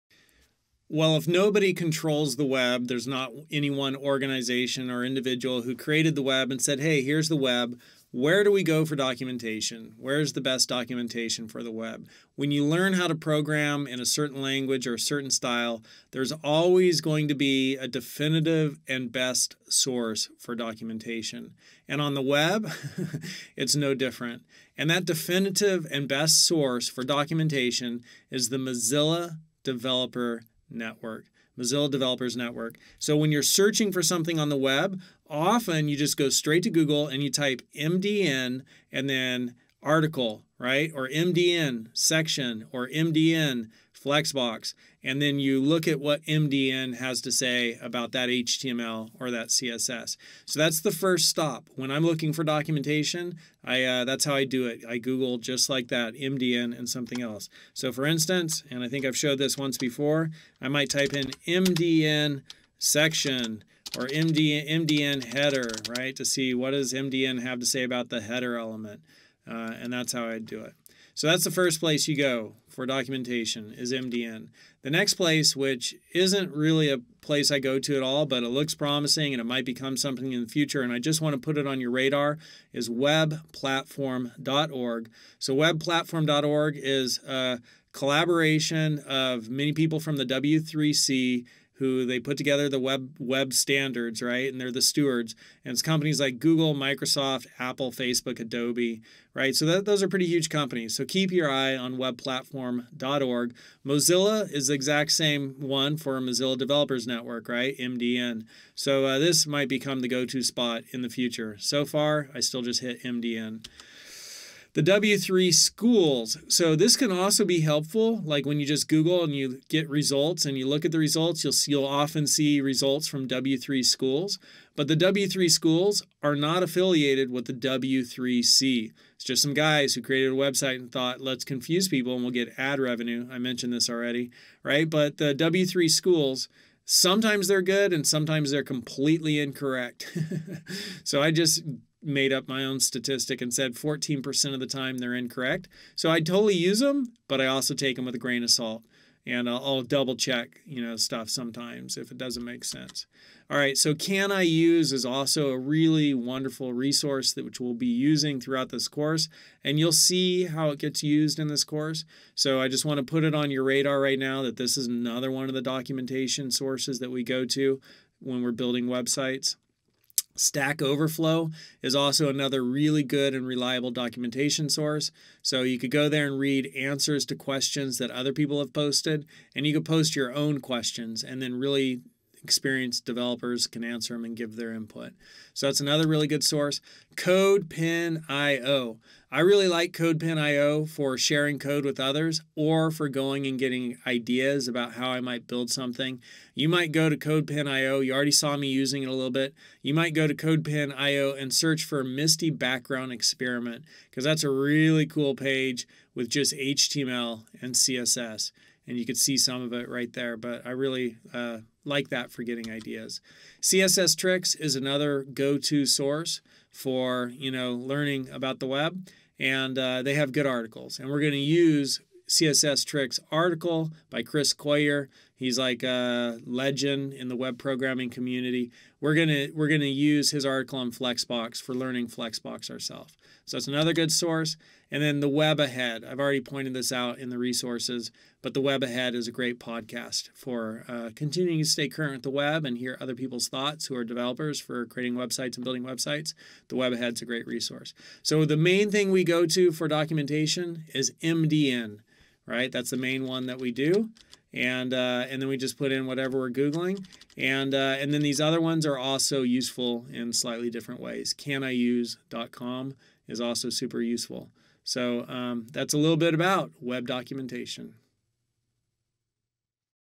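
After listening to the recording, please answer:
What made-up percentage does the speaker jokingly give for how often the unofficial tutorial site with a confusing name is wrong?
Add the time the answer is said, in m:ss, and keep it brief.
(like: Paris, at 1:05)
14%, at 2:23.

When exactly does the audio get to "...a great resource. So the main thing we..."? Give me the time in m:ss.
4:07.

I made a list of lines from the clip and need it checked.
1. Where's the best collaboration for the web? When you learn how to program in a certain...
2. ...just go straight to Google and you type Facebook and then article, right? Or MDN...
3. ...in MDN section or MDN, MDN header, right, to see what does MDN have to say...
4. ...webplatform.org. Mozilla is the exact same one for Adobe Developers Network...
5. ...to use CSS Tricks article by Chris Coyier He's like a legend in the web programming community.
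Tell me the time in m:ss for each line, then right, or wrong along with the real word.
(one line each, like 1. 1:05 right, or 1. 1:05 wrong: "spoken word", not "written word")
1. 0:09 wrong: "documentation", not "collaboration"
2. 0:35 wrong: "MDN", not "Facebook"
3. 1:01 right
4. 1:41 wrong: "Mozilla", not "Adobe"
5. 3:41 right.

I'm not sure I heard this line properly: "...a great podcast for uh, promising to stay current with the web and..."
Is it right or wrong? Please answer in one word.
wrong.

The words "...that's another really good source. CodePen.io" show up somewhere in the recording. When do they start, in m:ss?
3:05.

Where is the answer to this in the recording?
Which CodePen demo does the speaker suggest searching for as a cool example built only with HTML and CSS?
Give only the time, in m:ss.
3:22.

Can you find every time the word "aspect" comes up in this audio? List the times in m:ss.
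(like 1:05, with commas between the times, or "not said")
not said.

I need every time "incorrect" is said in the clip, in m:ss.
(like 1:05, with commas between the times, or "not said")
2:19, 2:25.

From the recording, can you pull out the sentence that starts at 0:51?
When I'm looking for documentation, I uh, that's how I do it.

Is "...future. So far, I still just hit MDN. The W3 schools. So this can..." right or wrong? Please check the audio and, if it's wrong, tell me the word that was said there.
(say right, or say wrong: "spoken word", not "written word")
right.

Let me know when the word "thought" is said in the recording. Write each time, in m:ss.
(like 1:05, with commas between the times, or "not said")
2:10, 4:03.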